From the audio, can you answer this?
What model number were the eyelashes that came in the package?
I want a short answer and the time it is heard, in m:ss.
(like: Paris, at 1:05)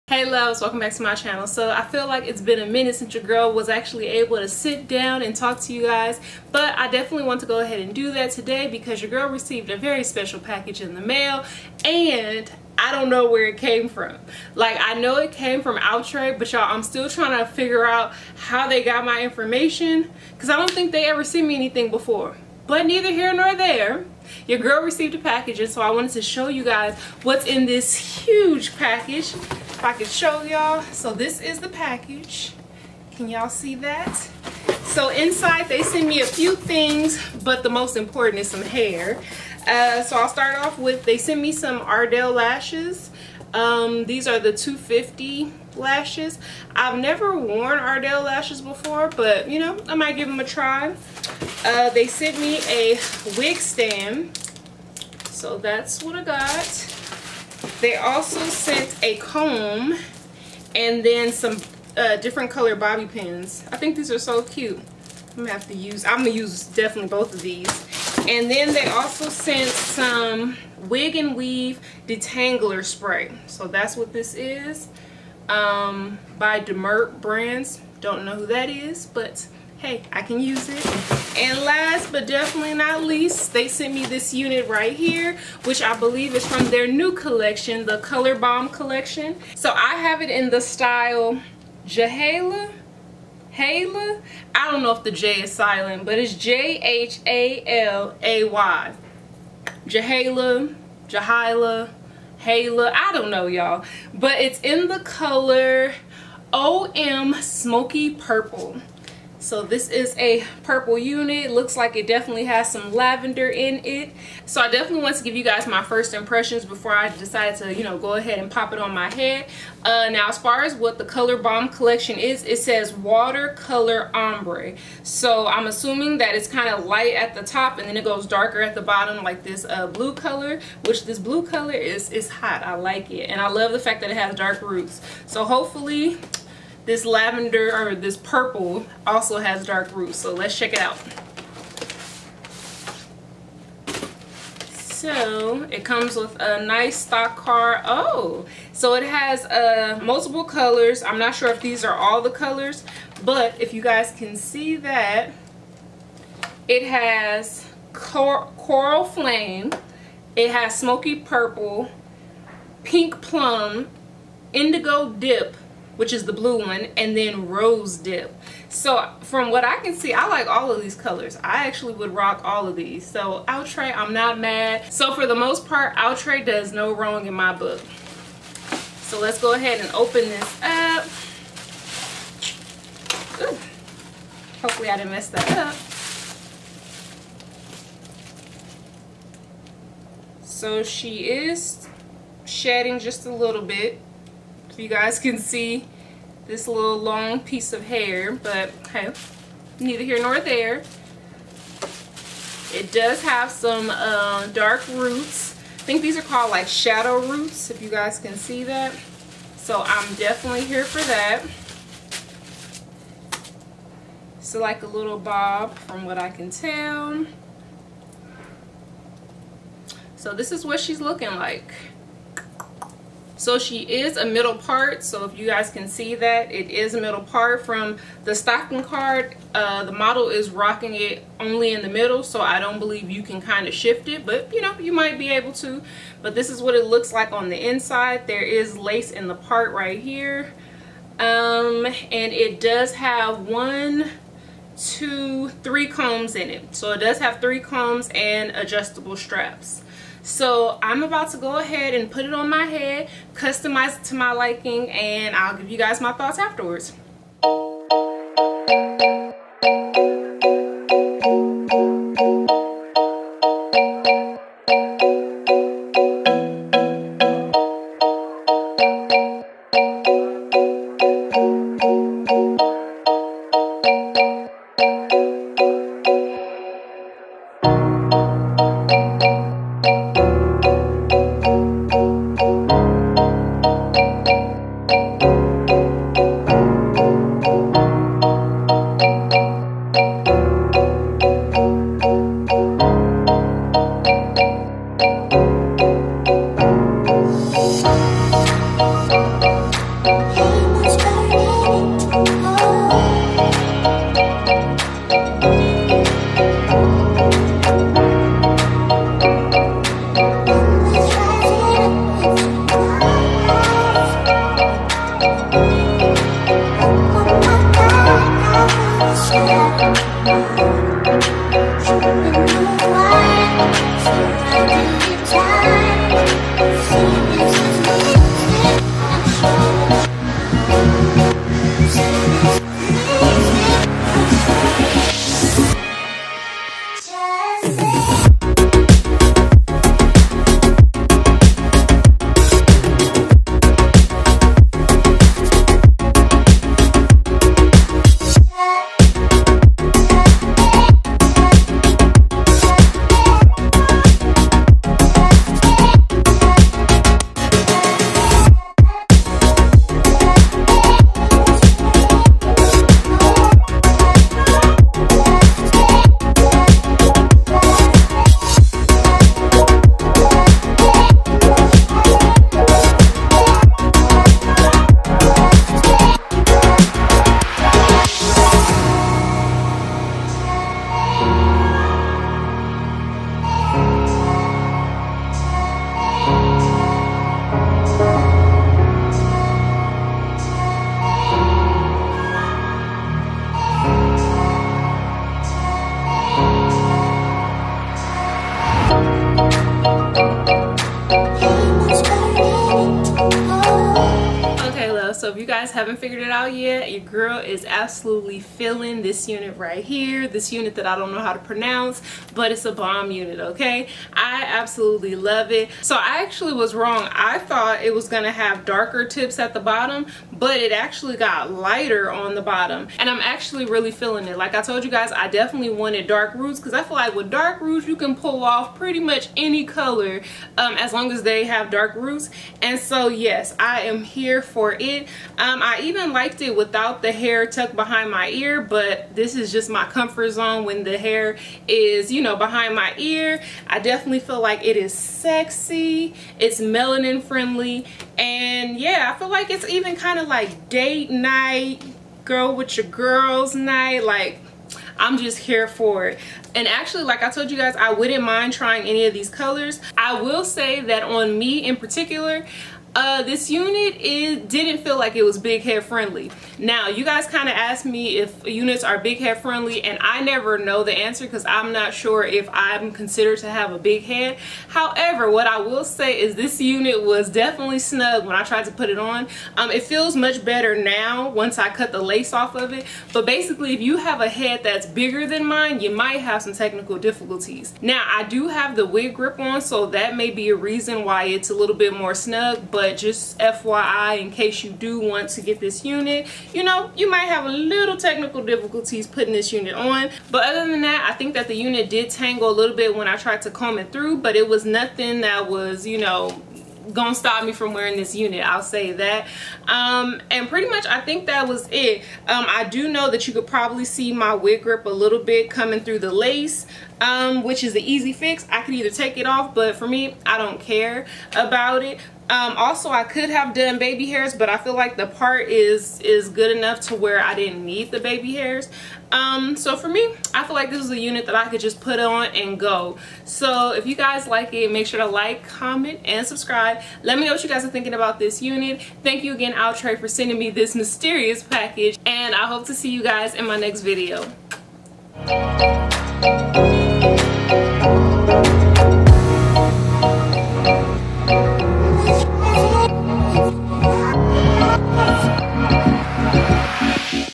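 250, at 0:44.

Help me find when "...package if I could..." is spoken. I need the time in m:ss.
0:28.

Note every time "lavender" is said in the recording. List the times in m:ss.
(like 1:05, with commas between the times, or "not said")
1:52, 2:17.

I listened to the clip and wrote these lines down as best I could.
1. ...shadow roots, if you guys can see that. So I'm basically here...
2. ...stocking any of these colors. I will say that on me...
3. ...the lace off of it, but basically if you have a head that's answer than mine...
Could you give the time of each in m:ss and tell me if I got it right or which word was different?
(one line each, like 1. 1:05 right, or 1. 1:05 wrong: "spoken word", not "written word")
1. 3:26 wrong: "definitely", not "basically"
2. 7:38 wrong: "trying", not "stocking"
3. 8:01 wrong: "bigger", not "answer".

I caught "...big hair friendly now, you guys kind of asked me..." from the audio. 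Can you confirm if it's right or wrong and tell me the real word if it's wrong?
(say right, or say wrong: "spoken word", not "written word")
right.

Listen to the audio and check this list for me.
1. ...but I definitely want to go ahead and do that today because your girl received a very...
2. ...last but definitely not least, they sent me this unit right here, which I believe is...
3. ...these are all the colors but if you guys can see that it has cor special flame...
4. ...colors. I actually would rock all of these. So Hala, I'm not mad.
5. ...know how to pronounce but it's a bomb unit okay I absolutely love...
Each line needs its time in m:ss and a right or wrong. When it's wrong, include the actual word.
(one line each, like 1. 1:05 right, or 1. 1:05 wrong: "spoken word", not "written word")
1. 0:06 right
2. 1:21 right
3. 2:31 wrong: "coral", not "special"
4. 2:50 wrong: "Outre", not "Hala"
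5. 6:51 right.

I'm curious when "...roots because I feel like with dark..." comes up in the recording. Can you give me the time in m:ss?
7:06.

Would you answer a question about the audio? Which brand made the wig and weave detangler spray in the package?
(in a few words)
Demert Brands.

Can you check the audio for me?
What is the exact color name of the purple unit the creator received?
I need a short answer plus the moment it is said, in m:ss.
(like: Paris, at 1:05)
OM Smoky Purple, at 1:46.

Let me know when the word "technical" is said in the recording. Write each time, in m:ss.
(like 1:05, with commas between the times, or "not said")
8:06, 8:17.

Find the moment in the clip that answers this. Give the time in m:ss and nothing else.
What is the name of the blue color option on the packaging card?
2:44.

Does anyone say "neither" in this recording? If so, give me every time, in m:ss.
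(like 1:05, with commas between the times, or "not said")
0:22, 3:19.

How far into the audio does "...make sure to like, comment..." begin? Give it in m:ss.
8:54.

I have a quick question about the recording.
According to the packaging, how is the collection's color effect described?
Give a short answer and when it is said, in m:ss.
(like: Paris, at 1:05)
watercolor ombre, at 2:02.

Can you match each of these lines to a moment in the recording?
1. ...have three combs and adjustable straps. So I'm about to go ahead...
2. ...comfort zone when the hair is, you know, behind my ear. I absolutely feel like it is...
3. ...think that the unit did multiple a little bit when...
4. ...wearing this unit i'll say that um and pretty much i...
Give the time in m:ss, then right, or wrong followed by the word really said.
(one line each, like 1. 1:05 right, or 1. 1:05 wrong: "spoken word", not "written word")
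1. 4:07 right
2. 7:19 wrong: "definitely", not "absolutely"
3. 8:21 wrong: "tangle", not "multiple"
4. 8:27 right.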